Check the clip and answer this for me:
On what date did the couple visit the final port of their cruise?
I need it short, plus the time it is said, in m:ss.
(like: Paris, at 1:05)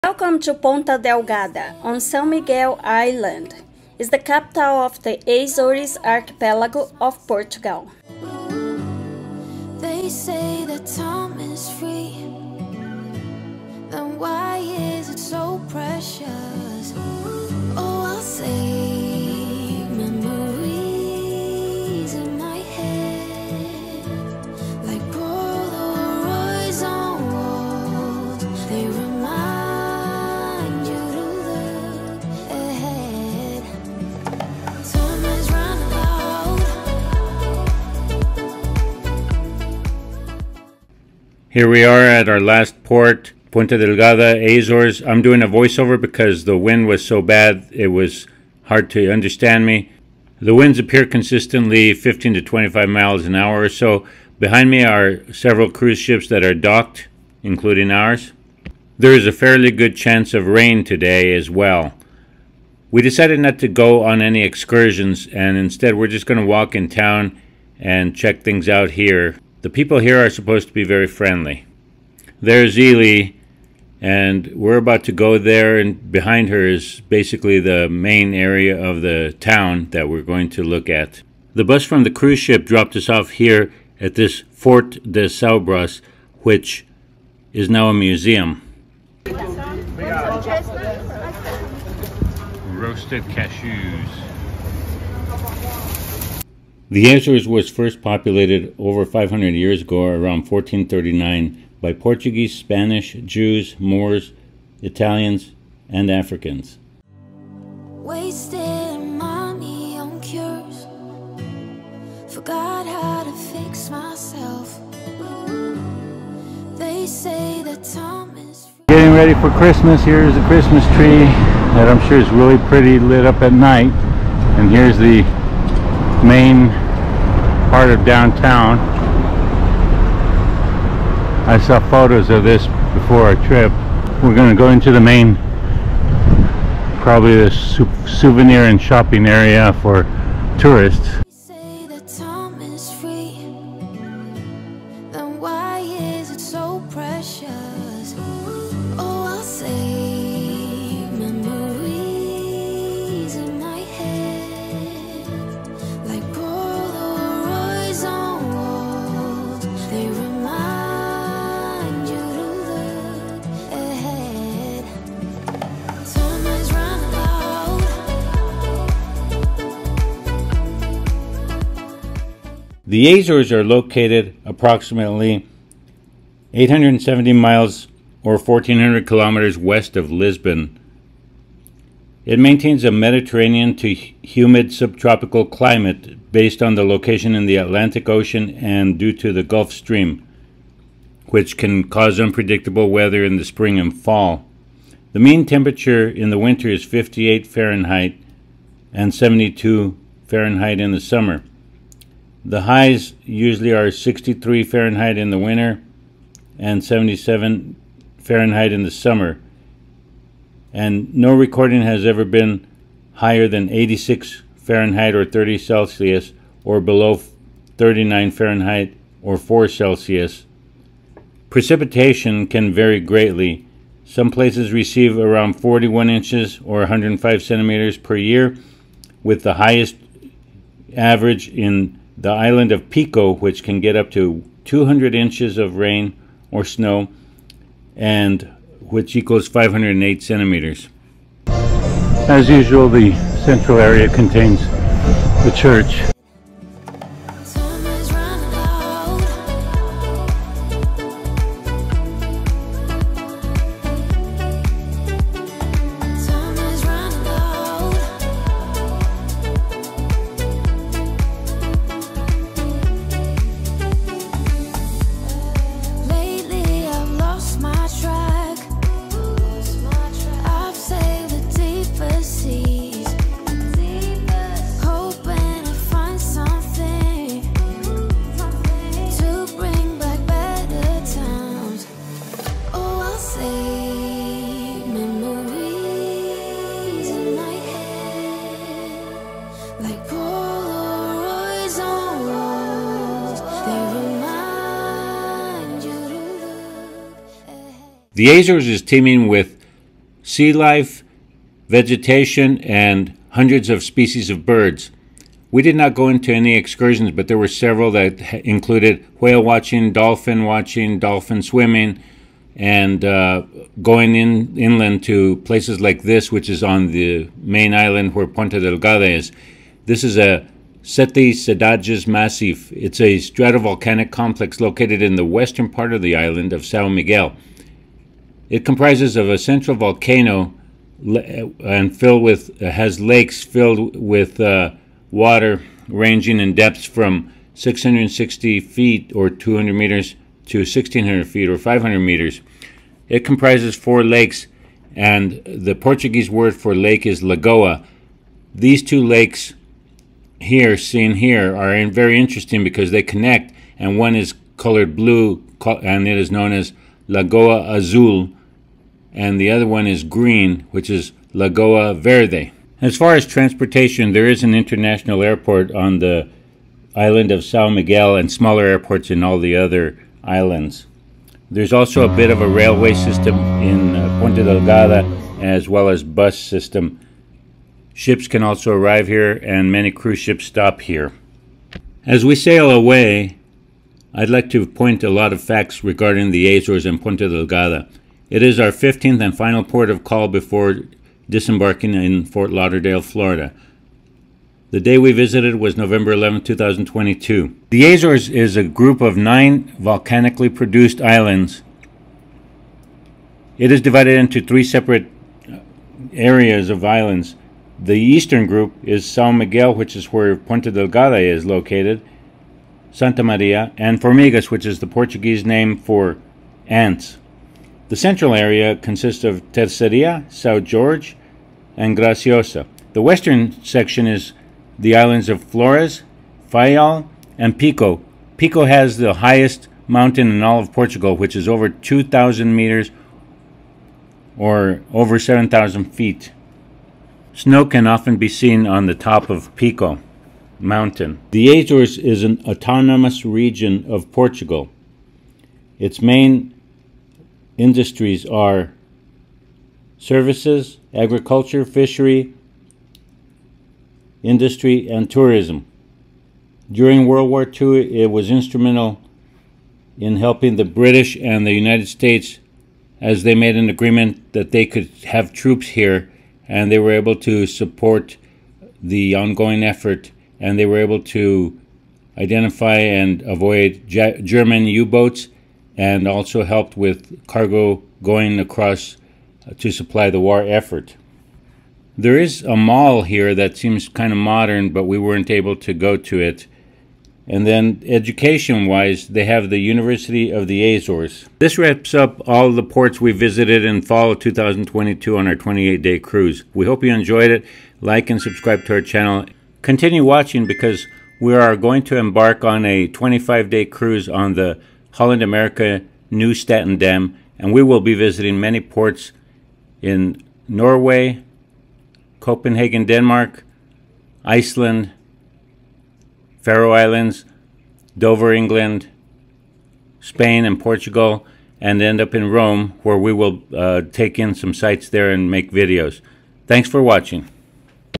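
November 11, 2022, at 6:35.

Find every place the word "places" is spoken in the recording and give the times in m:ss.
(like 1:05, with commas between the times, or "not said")
3:44, 5:15.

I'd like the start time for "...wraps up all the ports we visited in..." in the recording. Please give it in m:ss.
8:11.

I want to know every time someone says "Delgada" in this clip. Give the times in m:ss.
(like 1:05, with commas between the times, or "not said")
0:00, 0:43, 5:18, 6:14, 6:27, 6:50.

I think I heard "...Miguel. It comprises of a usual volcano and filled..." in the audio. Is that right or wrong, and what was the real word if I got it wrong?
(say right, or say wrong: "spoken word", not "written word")
wrong: "central", not "usual".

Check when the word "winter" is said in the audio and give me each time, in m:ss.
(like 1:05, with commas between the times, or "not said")
3:16, 3:25.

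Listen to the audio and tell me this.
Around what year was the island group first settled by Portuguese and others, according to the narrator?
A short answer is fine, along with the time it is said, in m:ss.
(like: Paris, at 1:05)
1439, at 1:40.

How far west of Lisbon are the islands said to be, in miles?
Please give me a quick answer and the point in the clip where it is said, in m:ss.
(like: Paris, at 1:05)
870 miles, at 2:56.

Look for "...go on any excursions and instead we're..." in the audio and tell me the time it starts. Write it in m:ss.
1:03.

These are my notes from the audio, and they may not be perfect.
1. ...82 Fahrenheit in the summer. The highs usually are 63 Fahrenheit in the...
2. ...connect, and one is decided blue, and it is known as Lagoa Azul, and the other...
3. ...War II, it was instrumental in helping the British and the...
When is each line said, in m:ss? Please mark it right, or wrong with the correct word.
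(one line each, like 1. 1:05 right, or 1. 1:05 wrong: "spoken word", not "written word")
1. 3:19 wrong: "72", not "82"
2. 5:53 wrong: "colored", not "decided"
3. 7:37 right.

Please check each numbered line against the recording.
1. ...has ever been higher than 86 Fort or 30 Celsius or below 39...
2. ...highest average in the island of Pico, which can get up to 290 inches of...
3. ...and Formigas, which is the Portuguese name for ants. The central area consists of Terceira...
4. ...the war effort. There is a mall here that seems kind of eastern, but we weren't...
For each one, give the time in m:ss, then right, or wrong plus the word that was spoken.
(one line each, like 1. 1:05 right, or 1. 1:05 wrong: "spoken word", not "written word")
1. 3:31 wrong: "Fahrenheit", not "Fort"
2. 3:49 wrong: "200", not "290"
3. 6:53 right
4. 8:00 wrong: "modern", not "eastern".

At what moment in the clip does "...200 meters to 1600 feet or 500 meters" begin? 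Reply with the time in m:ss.
5:39.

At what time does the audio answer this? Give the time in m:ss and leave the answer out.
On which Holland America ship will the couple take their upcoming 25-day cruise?
8:26.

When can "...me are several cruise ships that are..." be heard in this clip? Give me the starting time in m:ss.
0:54.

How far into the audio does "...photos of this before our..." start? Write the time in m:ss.
2:11.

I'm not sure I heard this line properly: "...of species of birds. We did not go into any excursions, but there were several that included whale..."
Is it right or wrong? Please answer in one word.
right.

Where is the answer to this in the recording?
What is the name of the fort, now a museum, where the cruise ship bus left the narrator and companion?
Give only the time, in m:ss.
1:24.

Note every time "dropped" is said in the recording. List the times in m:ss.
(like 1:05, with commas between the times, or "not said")
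1:22.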